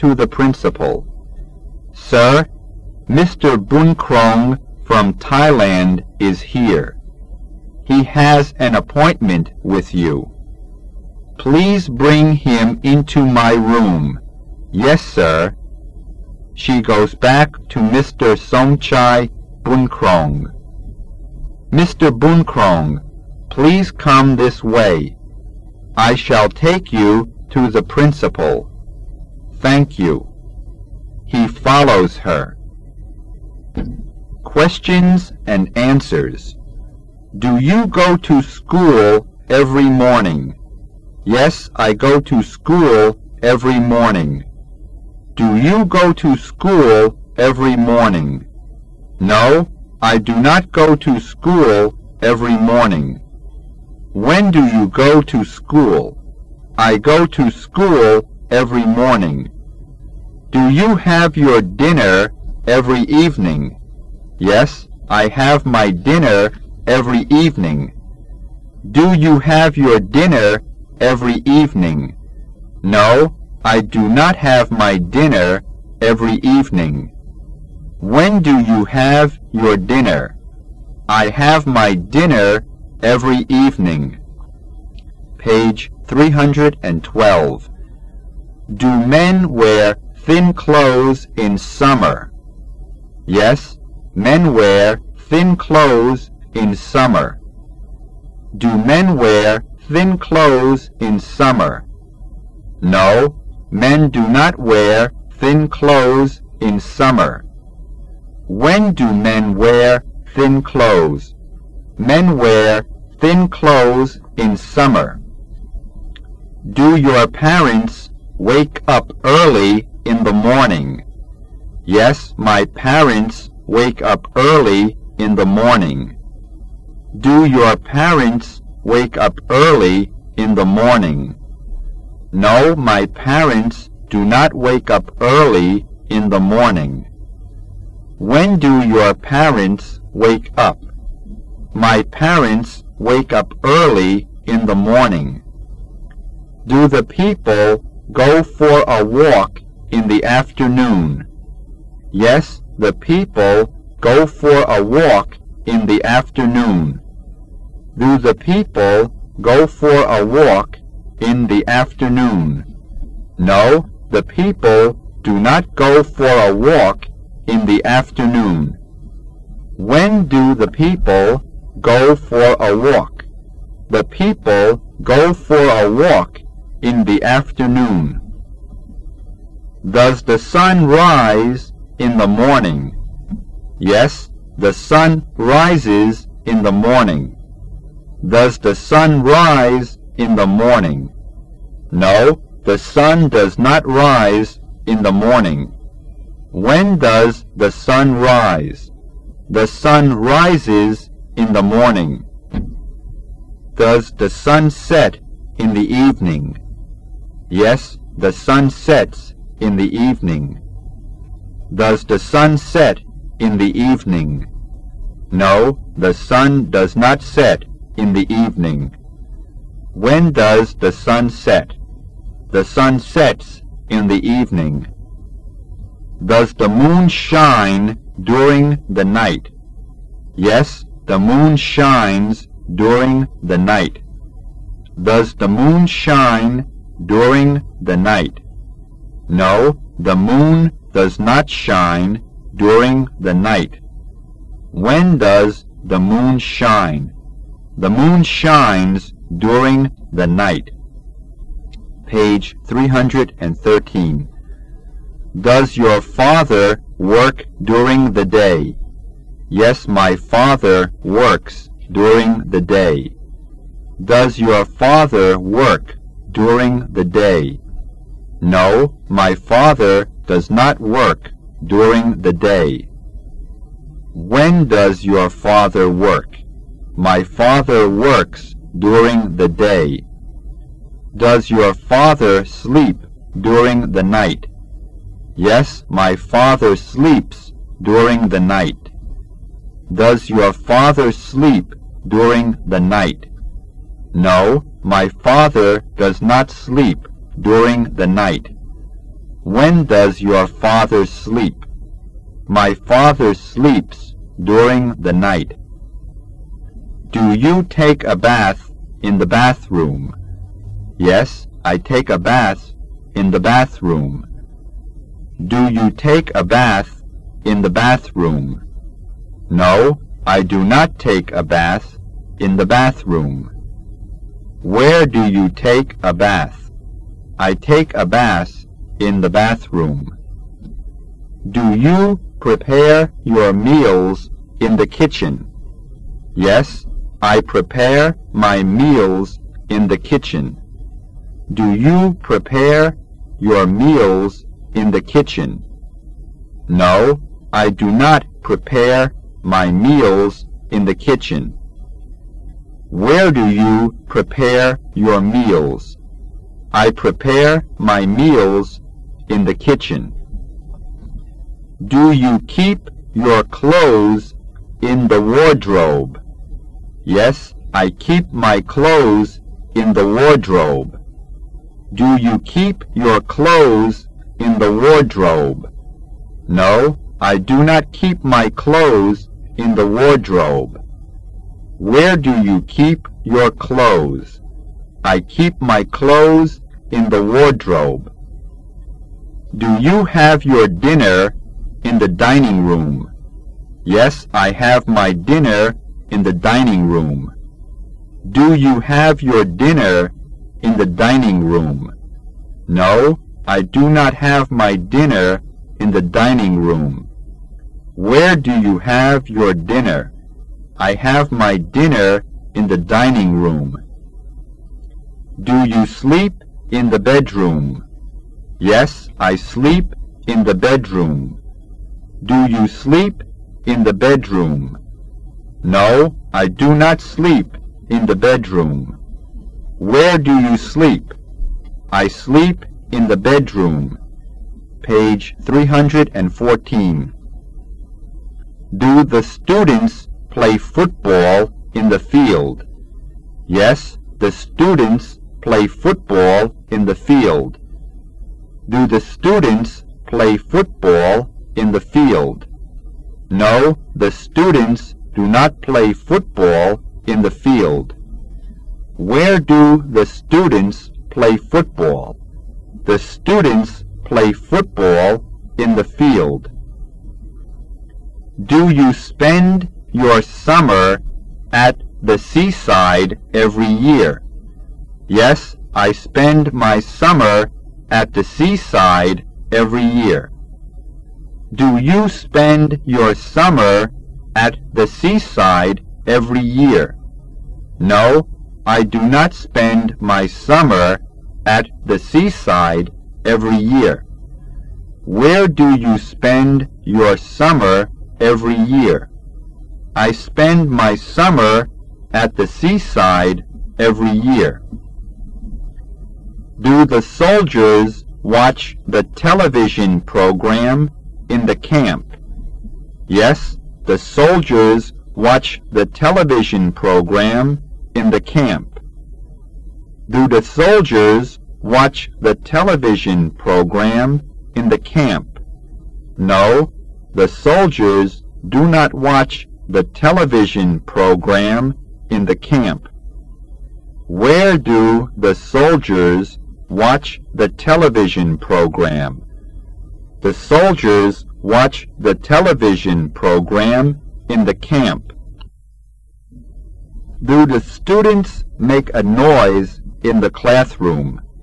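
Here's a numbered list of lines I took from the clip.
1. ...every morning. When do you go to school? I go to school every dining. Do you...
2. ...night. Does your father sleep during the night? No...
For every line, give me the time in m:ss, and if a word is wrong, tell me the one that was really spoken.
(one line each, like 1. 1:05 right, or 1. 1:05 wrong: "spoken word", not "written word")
1. 0:52 wrong: "morning", not "dining"
2. 4:48 right.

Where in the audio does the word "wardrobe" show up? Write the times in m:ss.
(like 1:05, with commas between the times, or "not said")
6:05, 6:10, 6:14, 6:19, 6:27.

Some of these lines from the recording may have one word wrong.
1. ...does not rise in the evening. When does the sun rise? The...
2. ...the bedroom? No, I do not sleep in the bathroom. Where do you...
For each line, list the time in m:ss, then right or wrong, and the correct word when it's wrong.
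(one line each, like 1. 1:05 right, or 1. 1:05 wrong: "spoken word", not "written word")
1. 3:13 wrong: "morning", not "evening"
2. 7:03 wrong: "bedroom", not "bathroom".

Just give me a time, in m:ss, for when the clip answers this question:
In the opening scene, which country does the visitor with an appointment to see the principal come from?
0:05.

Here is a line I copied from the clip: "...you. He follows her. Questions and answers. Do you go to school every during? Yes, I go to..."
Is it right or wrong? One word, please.
wrong.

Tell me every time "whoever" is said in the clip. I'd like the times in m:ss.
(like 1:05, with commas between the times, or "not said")
not said.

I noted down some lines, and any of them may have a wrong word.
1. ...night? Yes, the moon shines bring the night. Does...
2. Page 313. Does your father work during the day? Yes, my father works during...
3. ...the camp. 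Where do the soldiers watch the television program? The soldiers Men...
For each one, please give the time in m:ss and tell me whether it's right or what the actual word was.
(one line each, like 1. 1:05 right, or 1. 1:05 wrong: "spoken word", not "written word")
1. 3:49 wrong: "during", not "bring"
2. 4:12 right
3. 8:52 wrong: "Watch", not "Men".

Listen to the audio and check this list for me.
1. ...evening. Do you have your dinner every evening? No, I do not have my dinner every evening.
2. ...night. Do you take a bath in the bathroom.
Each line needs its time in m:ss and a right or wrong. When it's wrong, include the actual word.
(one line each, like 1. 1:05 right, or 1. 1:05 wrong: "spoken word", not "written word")
1. 1:07 right
2. 5:05 right.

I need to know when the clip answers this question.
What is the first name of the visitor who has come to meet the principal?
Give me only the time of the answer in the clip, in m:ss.
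0:18.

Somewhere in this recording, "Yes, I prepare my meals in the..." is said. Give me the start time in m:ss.
5:36.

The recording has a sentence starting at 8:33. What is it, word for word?
Yes, the soldiers watch the television program in the camp?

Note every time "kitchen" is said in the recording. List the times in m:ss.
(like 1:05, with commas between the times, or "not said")
5:34, 5:39, 5:45, 5:50, 5:59.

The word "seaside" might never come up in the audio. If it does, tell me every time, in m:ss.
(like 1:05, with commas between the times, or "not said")
7:52, 7:58, 8:04, 8:11, 8:22.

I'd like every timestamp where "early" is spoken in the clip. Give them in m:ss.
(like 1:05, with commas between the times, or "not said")
1:59, 2:04, 2:09, 2:15, 2:23.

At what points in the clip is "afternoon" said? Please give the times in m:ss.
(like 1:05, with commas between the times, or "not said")
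2:30, 2:36, 2:41, 2:47, 2:57.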